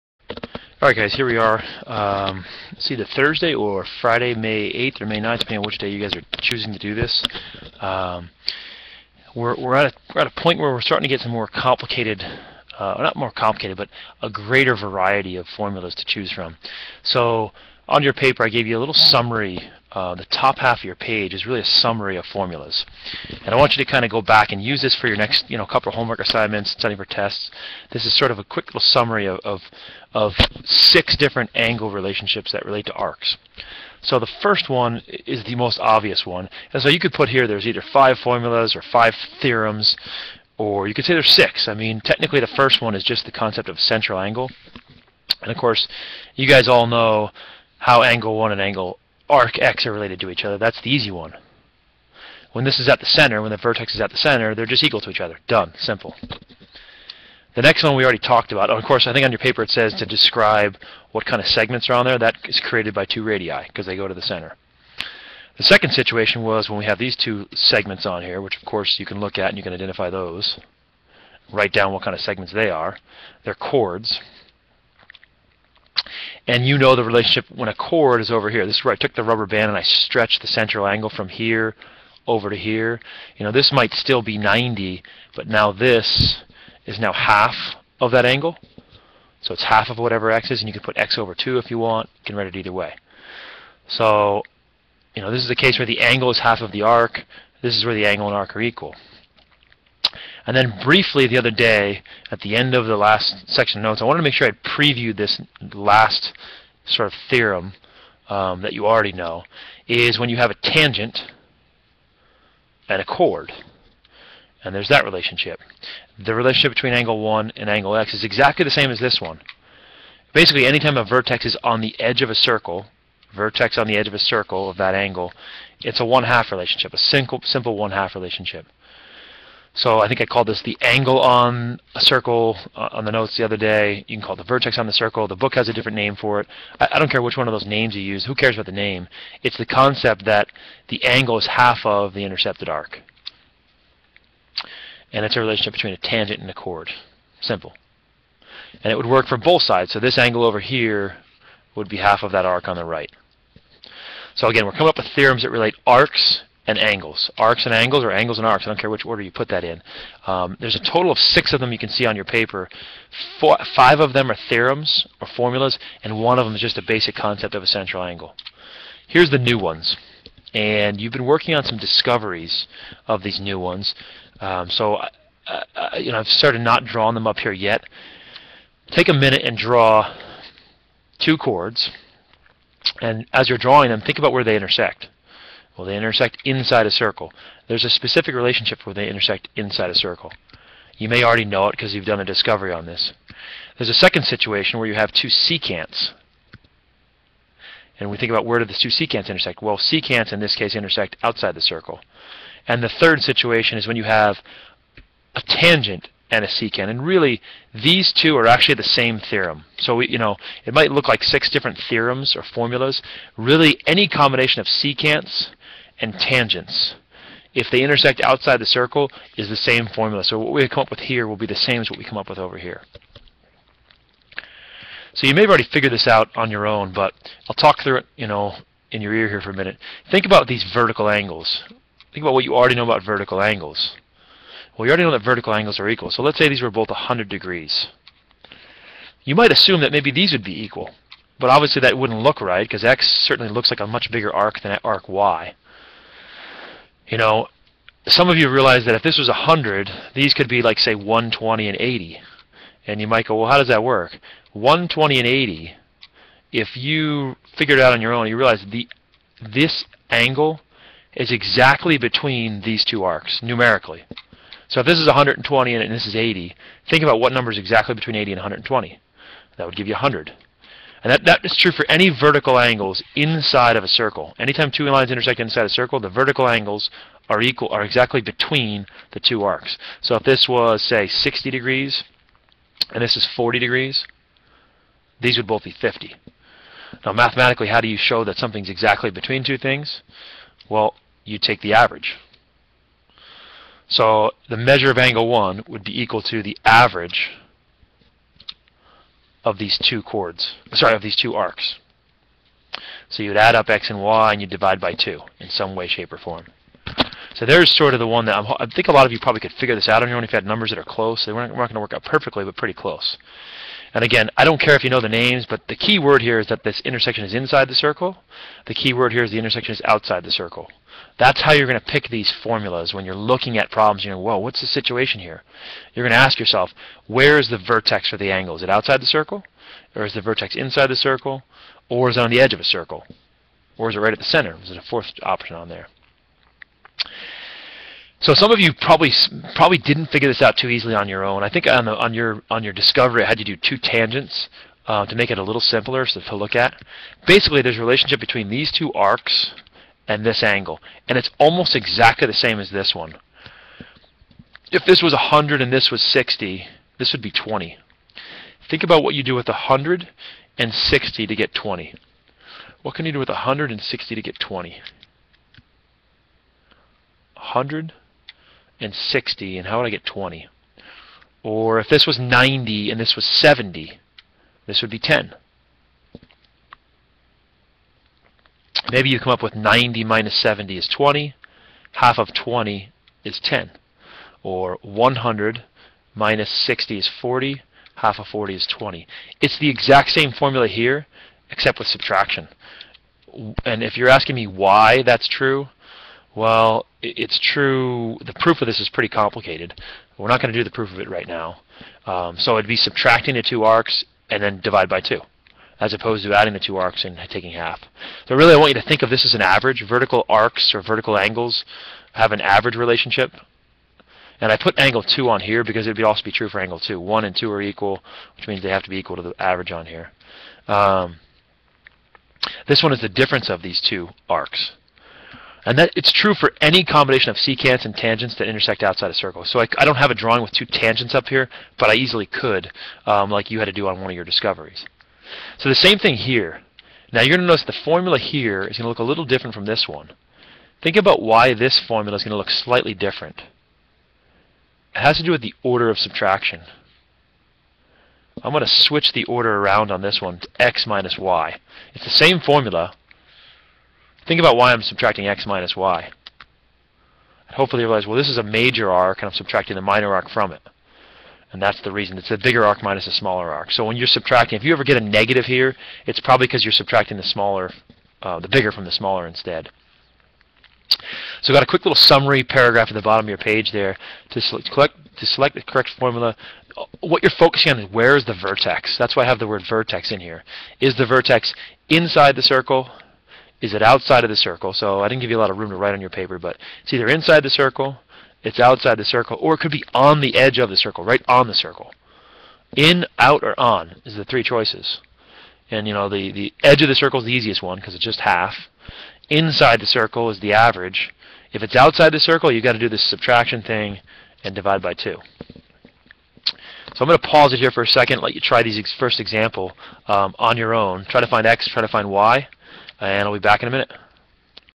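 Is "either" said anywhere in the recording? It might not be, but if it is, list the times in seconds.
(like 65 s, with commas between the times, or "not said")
2 s, 37 s, 92 s, 486 s.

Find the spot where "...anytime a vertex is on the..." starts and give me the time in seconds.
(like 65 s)
120 s.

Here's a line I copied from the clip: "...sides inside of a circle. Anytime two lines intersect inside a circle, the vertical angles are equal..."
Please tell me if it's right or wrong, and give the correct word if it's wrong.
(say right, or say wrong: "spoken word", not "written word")
wrong: "angles", not "sides".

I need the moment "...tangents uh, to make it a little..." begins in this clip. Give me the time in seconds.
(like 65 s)
343 s.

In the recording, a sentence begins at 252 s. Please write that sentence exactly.
And you might go, well, how does that work?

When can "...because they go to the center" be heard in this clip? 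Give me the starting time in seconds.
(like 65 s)
63 s.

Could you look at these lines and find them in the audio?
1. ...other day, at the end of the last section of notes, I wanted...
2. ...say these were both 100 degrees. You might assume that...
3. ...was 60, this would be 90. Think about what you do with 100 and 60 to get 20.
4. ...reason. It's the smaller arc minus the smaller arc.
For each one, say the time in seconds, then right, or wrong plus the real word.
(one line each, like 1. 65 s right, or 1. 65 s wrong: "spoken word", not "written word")
1. 101 s right
2. 236 s right
3. 355 s wrong: "20", not "90"
4. 461 s wrong: "bigger", not "smaller".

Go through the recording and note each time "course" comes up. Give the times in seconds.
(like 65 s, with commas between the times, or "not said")
45 s, 58 s, 68 s.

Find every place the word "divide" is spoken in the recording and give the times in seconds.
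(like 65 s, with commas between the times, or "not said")
304 s, 404 s, 504 s.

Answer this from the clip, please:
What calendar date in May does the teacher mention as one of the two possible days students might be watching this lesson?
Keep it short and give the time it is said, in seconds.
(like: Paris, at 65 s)
May 8th, at 4 s.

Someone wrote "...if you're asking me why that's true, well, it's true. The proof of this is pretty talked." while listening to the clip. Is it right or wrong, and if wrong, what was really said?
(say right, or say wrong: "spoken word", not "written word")
wrong: "complicated", not "talked".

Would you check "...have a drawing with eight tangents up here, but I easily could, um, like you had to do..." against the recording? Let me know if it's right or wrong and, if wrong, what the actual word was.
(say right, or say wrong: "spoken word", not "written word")
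wrong: "two", not "eight".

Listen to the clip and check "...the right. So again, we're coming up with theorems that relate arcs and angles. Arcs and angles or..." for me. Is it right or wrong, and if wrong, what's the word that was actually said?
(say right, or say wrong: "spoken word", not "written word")
right.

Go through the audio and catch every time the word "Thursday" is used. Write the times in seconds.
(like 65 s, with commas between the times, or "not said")
3 s.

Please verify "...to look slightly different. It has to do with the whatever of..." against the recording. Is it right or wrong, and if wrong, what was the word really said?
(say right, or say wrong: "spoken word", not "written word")
wrong: "order", not "whatever".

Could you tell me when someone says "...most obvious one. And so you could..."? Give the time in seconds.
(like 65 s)
35 s.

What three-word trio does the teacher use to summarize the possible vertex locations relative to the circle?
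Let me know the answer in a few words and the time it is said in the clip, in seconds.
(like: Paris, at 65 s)
In, out, or on, at 492 s.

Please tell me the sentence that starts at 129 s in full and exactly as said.
So I think I called this the angle on a circle uh, on the notes the other day.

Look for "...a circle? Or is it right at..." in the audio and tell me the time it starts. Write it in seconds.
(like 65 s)
332 s.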